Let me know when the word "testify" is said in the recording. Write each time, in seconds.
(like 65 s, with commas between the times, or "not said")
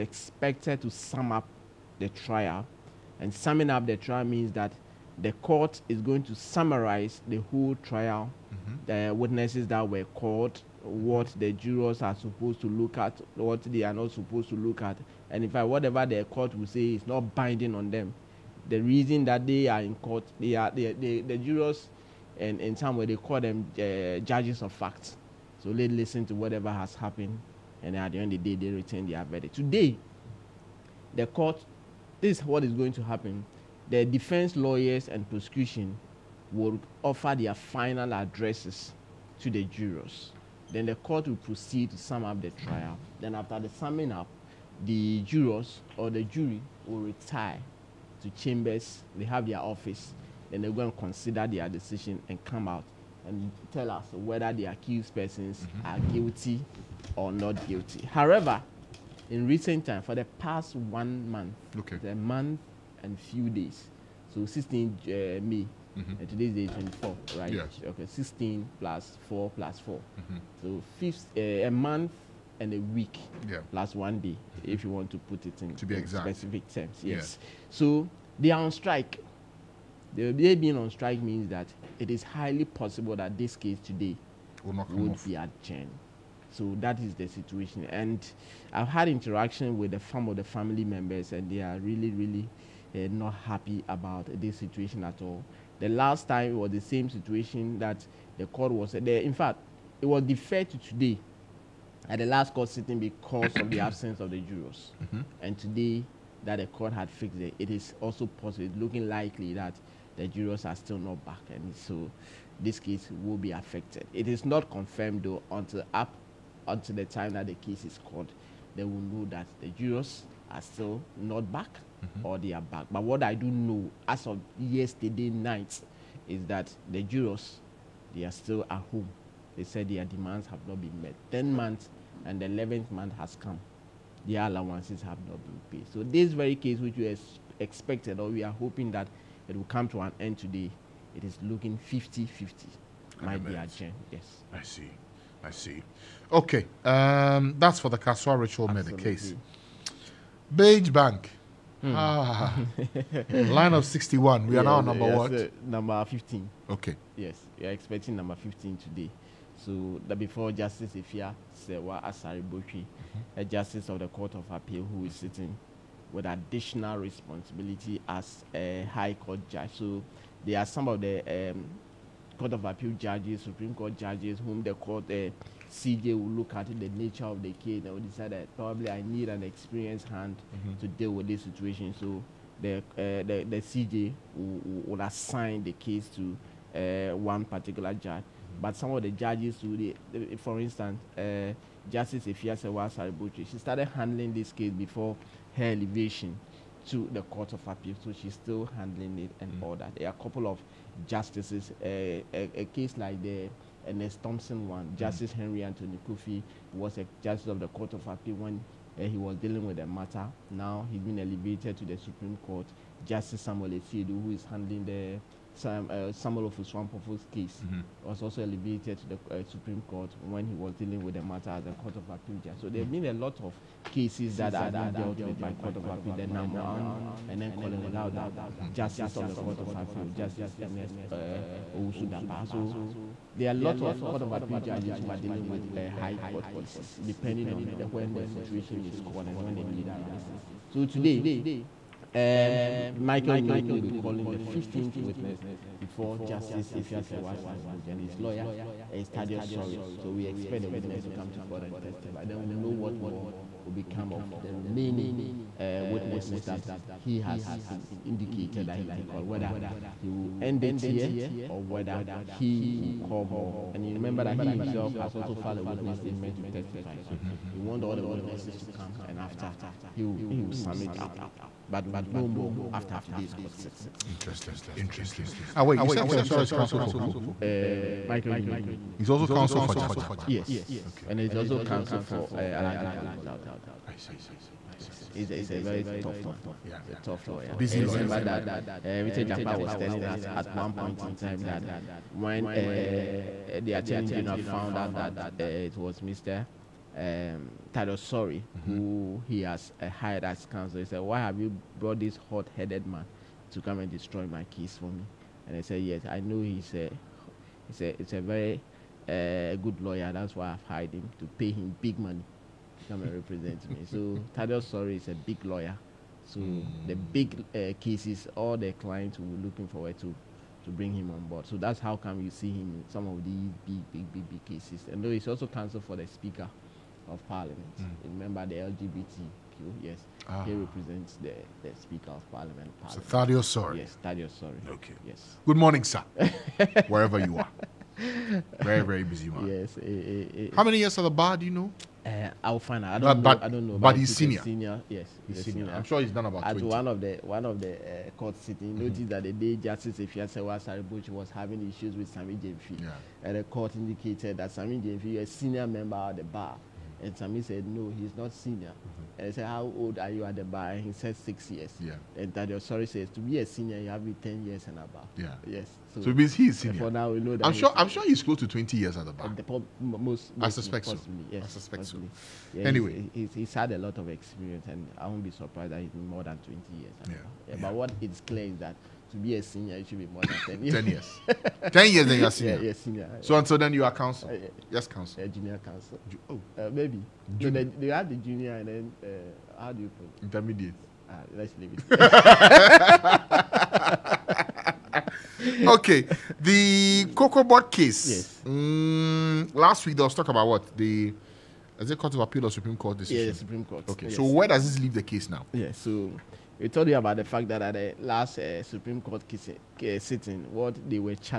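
251 s, 266 s.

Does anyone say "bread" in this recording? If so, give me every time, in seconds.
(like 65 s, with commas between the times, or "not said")
not said.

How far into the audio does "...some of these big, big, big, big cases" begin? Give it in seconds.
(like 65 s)
322 s.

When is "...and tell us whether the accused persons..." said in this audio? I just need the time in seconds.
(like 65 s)
53 s.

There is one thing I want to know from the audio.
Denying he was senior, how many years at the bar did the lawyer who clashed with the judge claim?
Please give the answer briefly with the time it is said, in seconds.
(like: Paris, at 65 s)
6 years, at 361 s.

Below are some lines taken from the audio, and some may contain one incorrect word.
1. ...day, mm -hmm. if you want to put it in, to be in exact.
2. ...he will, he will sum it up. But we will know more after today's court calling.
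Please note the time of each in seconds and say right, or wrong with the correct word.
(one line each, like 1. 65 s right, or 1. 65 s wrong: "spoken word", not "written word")
1. 74 s right
2. 269 s wrong: "sitting", not "calling".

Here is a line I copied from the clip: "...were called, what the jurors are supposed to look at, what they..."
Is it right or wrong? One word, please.
right.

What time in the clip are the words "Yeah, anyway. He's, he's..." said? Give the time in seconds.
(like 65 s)
372 s.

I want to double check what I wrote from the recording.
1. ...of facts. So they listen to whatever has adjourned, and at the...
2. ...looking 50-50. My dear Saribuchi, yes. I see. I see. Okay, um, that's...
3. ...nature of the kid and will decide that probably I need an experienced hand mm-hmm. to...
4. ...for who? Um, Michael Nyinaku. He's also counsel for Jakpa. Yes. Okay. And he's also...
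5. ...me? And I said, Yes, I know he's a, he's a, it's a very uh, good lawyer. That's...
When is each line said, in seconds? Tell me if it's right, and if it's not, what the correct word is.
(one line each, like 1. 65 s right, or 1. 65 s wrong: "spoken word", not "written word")
1. 24 s wrong: "happened", not "adjourned"
2. 141 s wrong: "Jen", not "Saribuchi"
3. 176 s right
4. 276 s right
5. 304 s right.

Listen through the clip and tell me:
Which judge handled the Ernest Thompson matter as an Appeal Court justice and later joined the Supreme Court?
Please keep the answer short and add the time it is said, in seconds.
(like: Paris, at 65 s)
Henry Anthony Kwofie, at 205 s.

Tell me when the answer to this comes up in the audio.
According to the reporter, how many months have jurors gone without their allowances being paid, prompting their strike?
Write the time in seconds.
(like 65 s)
131 s.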